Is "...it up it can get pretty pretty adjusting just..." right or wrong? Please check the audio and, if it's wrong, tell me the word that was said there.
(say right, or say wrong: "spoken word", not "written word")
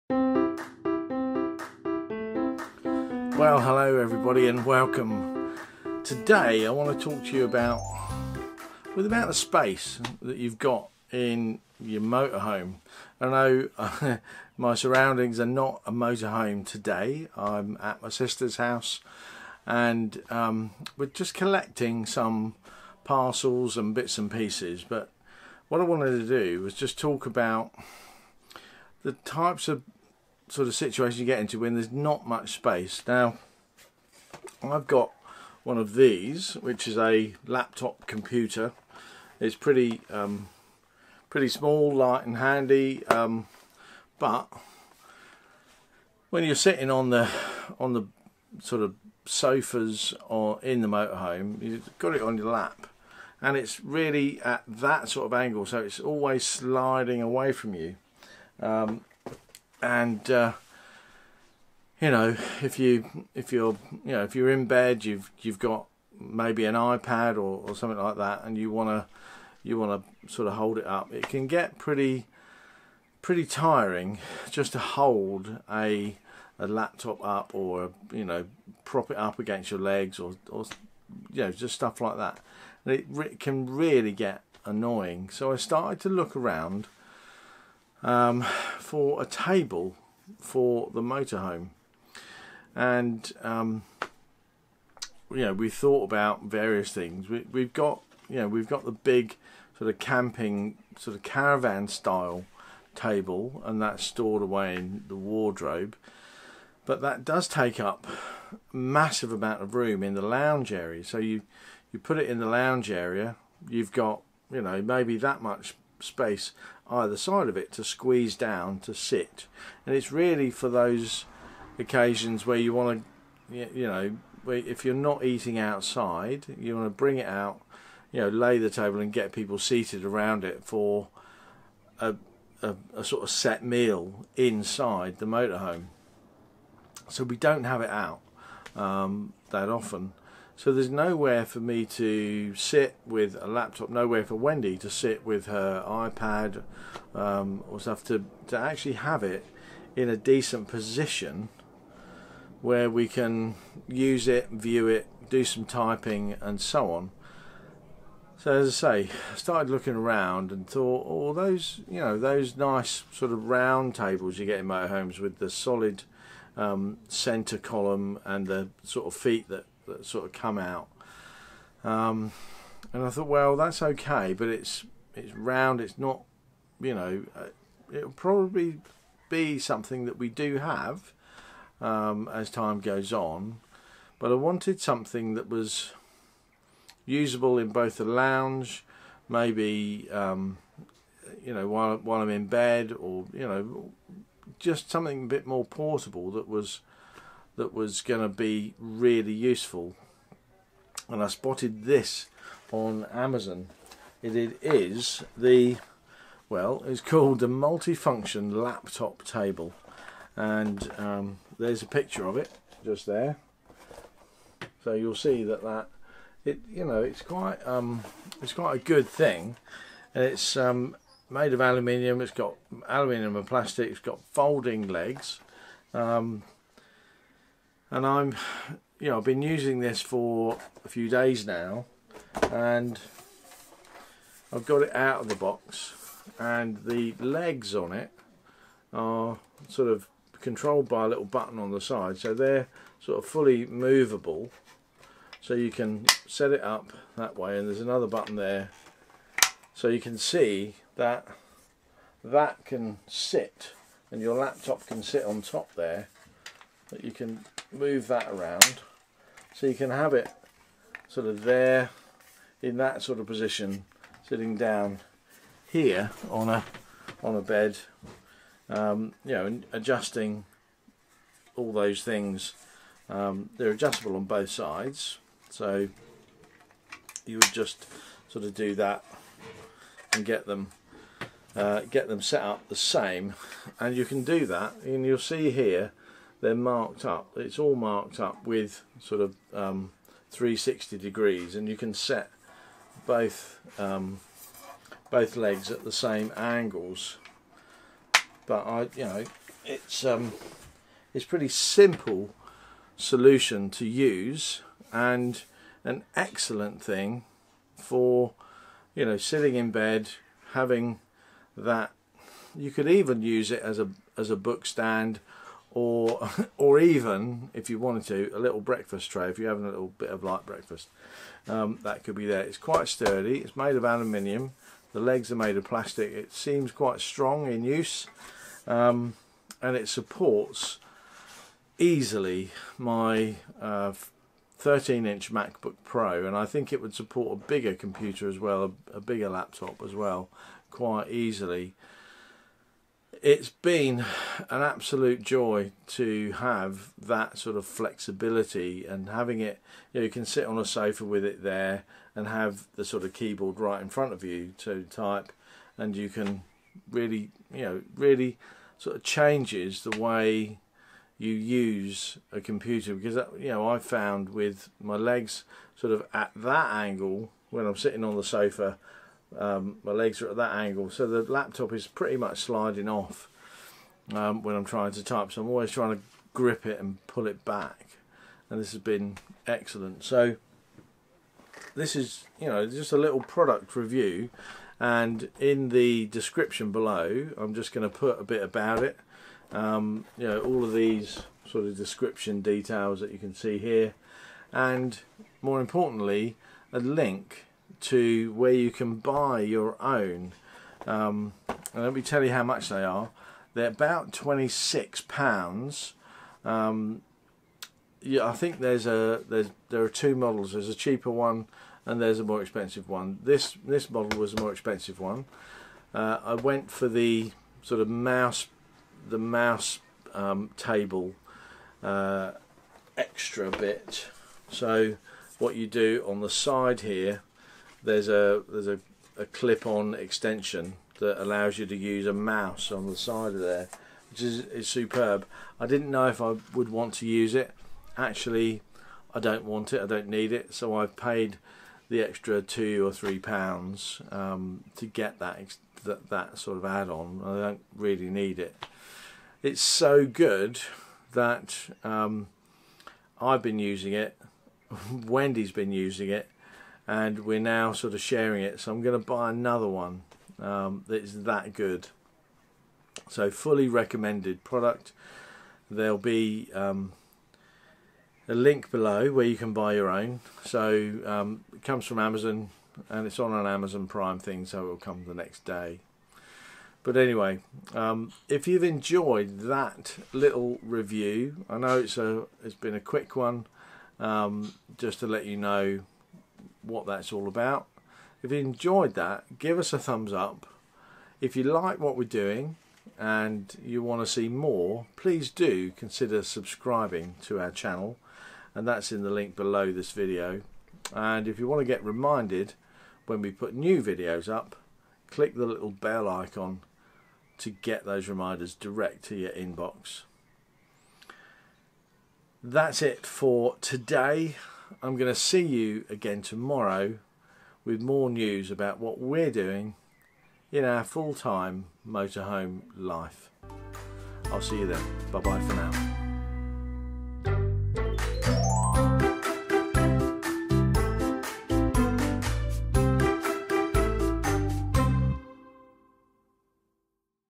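wrong: "tiring", not "adjusting".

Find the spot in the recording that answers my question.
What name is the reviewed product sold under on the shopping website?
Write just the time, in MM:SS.
03:27.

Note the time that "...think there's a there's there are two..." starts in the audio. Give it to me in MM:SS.
06:48.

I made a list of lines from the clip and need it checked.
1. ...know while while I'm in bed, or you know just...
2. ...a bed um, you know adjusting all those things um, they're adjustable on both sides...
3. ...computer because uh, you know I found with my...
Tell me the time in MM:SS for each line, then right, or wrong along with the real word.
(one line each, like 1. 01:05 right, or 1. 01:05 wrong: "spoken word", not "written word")
1. 03:11 right
2. 04:27 right
3. 06:02 right.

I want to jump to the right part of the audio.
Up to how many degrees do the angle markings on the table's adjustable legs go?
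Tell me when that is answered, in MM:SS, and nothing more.
04:50.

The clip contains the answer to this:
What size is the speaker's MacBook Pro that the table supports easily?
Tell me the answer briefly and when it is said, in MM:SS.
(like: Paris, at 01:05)
13 inch, at 05:34.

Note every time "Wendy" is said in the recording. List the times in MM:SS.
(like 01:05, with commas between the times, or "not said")
02:24, 07:34.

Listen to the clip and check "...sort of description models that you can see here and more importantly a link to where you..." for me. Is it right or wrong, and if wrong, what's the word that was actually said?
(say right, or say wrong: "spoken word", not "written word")
wrong: "details", not "models".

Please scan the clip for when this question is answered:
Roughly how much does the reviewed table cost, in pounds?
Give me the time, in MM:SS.
06:44.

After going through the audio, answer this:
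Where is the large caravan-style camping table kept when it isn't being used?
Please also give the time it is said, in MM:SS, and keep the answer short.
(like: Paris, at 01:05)
In the wardrobe, at 01:45.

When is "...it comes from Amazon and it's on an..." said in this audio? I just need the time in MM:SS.
07:51.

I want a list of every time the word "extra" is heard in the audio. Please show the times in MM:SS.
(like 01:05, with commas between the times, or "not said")
07:02, 07:22.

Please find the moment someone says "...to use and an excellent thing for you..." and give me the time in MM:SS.
05:03.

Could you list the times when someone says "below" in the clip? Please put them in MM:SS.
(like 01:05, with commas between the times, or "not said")
06:26, 07:48, 08:19.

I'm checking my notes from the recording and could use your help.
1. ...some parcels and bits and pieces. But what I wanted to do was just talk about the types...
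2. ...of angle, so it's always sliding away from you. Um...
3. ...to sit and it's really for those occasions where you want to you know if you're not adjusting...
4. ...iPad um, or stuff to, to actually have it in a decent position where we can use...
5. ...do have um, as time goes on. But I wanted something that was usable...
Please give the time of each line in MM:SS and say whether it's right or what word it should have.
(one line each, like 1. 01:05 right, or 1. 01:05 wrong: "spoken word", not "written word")
1. 00:22 right
2. 00:55 right
3. 01:58 wrong: "eating", not "adjusting"
4. 02:25 right
5. 03:00 right.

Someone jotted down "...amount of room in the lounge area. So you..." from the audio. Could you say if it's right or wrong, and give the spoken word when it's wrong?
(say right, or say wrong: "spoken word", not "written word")
right.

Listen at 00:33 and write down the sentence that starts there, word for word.
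Now, I've got one of these, which is a laptop computer.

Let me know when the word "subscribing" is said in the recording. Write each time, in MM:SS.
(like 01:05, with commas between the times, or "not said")
08:16.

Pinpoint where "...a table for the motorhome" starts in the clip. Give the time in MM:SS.
01:29.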